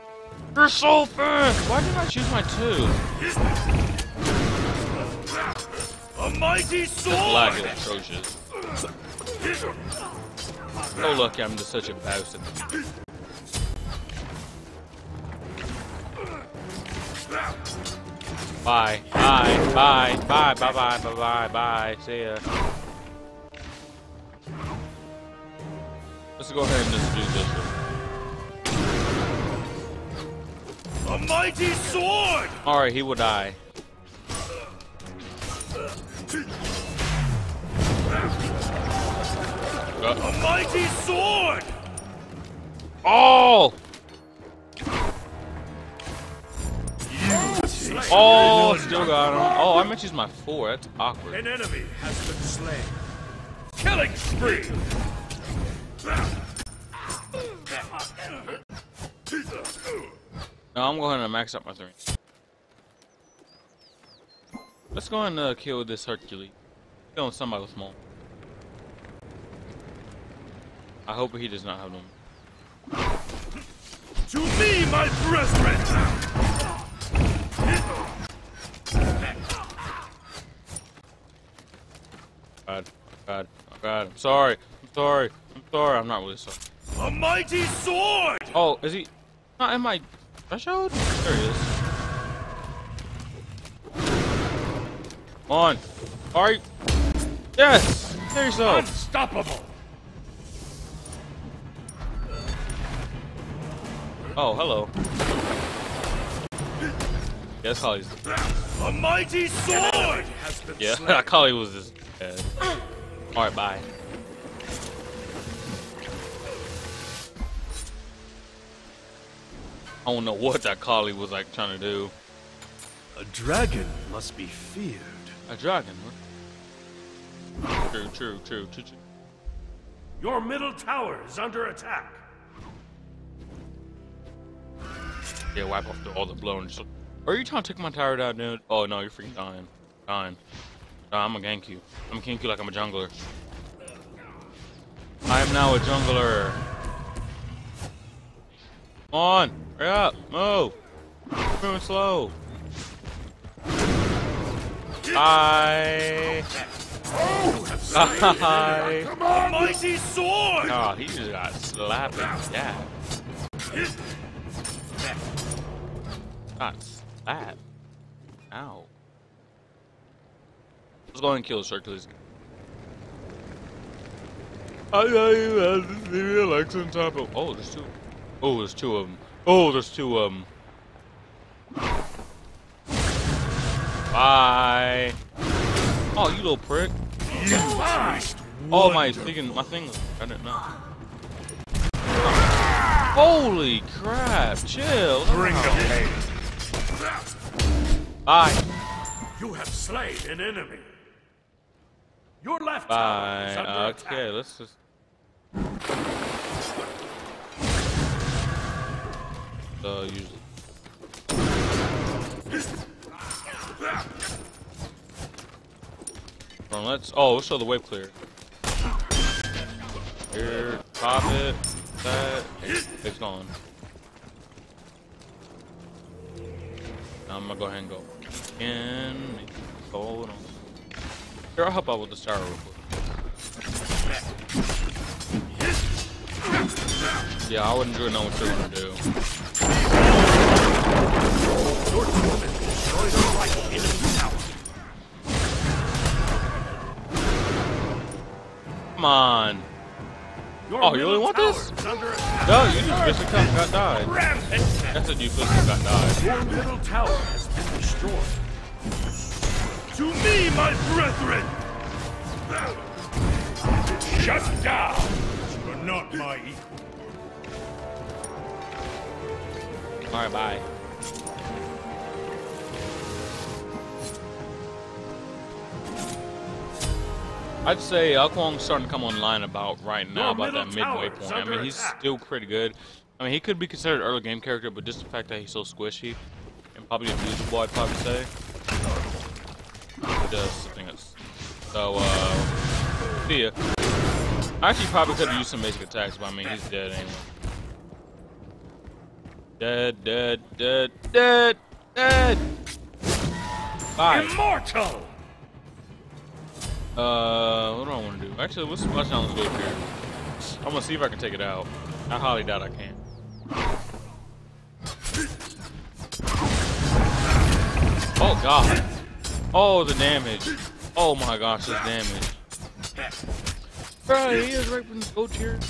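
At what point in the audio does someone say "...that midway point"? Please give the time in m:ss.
4:40.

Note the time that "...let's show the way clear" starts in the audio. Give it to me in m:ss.
3:37.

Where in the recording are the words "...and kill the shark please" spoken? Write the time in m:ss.
2:51.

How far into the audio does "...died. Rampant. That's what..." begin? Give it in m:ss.
4:13.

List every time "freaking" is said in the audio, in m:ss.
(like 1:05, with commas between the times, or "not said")
2:19.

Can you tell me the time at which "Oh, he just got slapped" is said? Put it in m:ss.
2:40.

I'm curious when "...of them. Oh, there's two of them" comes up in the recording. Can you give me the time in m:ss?
2:58.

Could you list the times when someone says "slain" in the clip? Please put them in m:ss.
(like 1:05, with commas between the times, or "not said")
0:52, 3:19.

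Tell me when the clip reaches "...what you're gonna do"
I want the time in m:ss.
3:58.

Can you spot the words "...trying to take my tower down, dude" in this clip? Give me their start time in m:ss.
2:17.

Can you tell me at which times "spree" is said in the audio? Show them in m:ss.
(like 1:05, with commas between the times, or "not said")
0:54.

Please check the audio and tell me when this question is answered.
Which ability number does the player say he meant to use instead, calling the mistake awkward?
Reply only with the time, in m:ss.
0:50.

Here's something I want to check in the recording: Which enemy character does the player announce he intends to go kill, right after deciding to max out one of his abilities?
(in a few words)
Hercules.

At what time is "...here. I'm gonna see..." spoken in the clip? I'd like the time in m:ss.
5:09.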